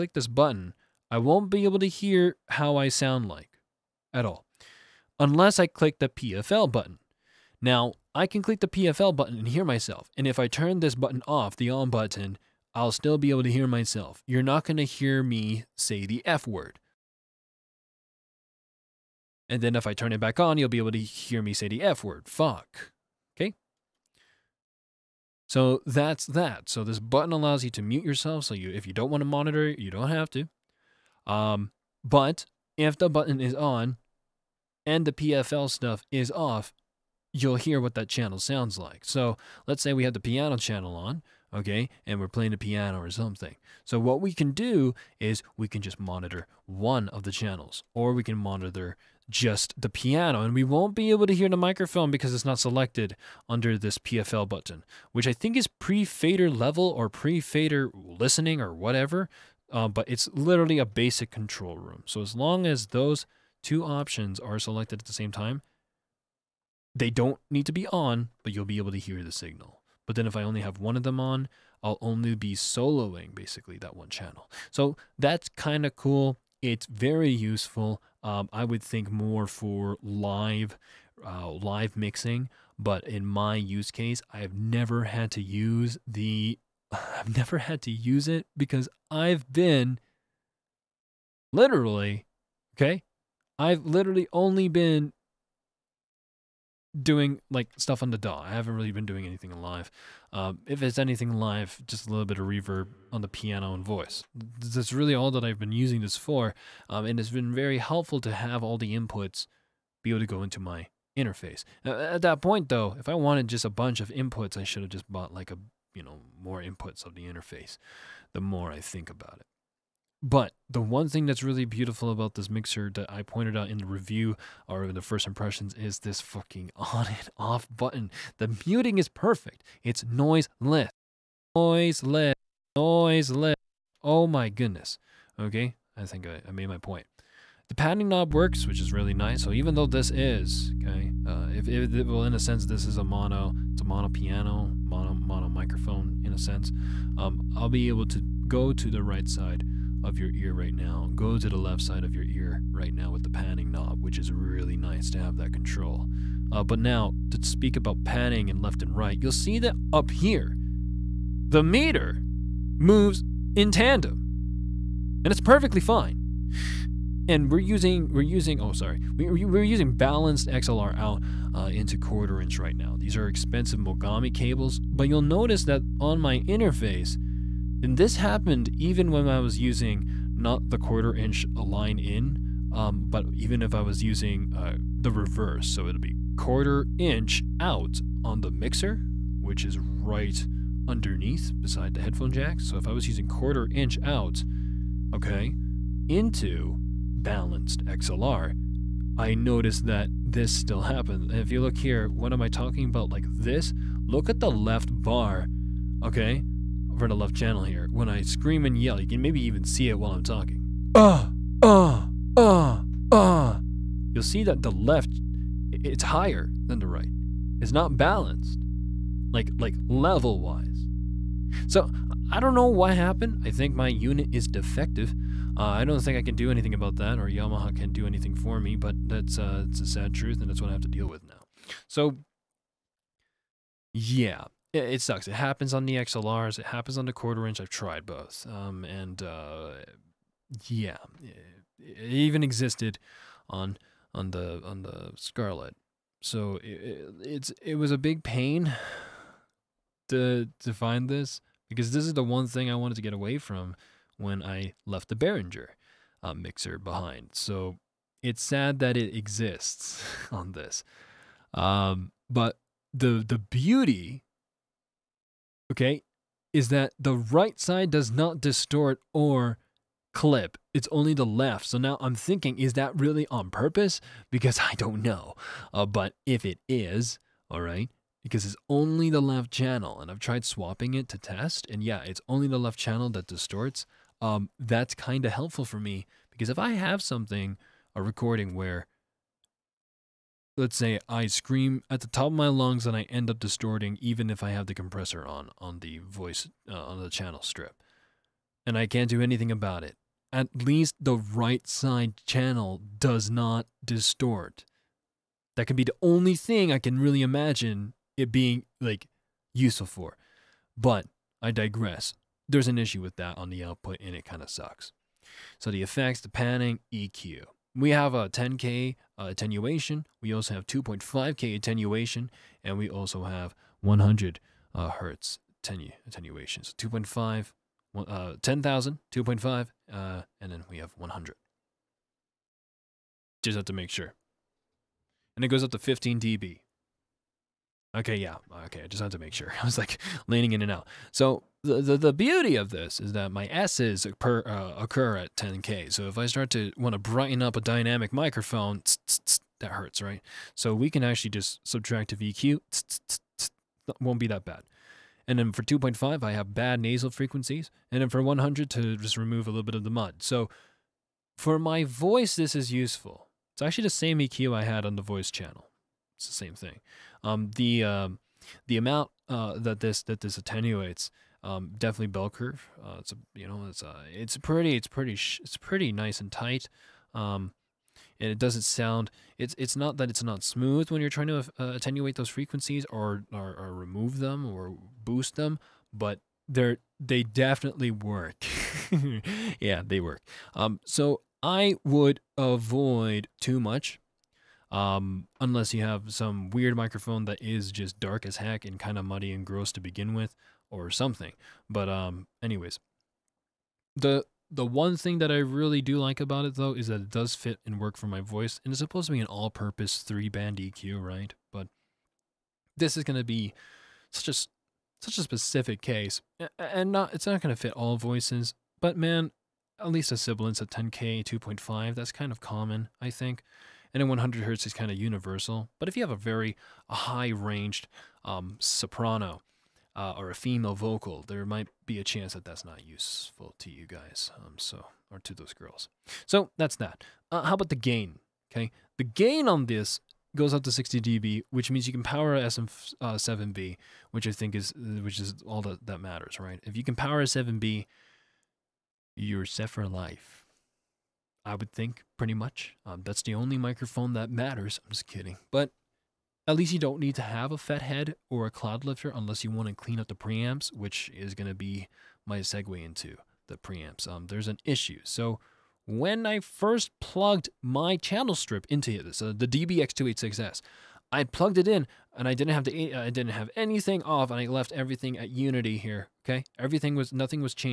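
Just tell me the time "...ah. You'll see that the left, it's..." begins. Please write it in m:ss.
3:33.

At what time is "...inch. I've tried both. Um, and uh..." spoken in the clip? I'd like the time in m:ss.
3:57.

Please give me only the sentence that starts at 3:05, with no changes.
So it'll be quarter inch out on the mixer, which is right underneath beside the headphone jack.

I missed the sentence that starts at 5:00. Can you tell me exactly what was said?
At least the right side channel does not distort.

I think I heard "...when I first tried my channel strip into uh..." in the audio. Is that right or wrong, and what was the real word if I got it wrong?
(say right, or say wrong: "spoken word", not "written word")
wrong: "plugged", not "tried".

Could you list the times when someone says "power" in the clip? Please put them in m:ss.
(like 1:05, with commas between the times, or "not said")
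7:22, 7:26.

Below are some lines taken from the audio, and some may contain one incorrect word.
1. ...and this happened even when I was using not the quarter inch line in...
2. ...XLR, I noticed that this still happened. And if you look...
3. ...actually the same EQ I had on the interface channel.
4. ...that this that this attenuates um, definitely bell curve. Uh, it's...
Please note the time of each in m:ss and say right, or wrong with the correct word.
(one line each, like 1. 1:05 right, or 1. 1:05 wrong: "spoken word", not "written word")
1. 2:57 right
2. 3:17 right
3. 6:03 wrong: "voice", not "interface"
4. 6:09 right.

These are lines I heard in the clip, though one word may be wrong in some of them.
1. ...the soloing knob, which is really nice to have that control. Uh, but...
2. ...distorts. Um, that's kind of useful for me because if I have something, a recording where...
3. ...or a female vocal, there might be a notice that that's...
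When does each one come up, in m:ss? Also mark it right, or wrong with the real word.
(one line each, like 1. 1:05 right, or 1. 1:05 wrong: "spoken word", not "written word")
1. 2:33 wrong: "panning", not "soloing"
2. 4:43 wrong: "helpful", not "useful"
3. 7:10 wrong: "chance", not "notice".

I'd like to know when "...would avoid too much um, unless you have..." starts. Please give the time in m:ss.
6:31.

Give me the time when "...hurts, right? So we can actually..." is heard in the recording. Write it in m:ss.
5:49.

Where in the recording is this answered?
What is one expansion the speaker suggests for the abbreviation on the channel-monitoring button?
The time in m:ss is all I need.
0:55.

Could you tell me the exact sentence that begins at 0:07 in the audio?
Now, I can click the PFL button and hear myself.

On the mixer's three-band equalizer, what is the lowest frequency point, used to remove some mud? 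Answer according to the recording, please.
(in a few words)
100 hertz.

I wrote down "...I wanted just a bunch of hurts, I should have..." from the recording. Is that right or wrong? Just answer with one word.
wrong.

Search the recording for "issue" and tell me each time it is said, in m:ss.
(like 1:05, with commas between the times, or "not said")
5:12, 7:44.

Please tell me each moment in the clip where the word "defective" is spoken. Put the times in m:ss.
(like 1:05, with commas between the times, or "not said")
3:44.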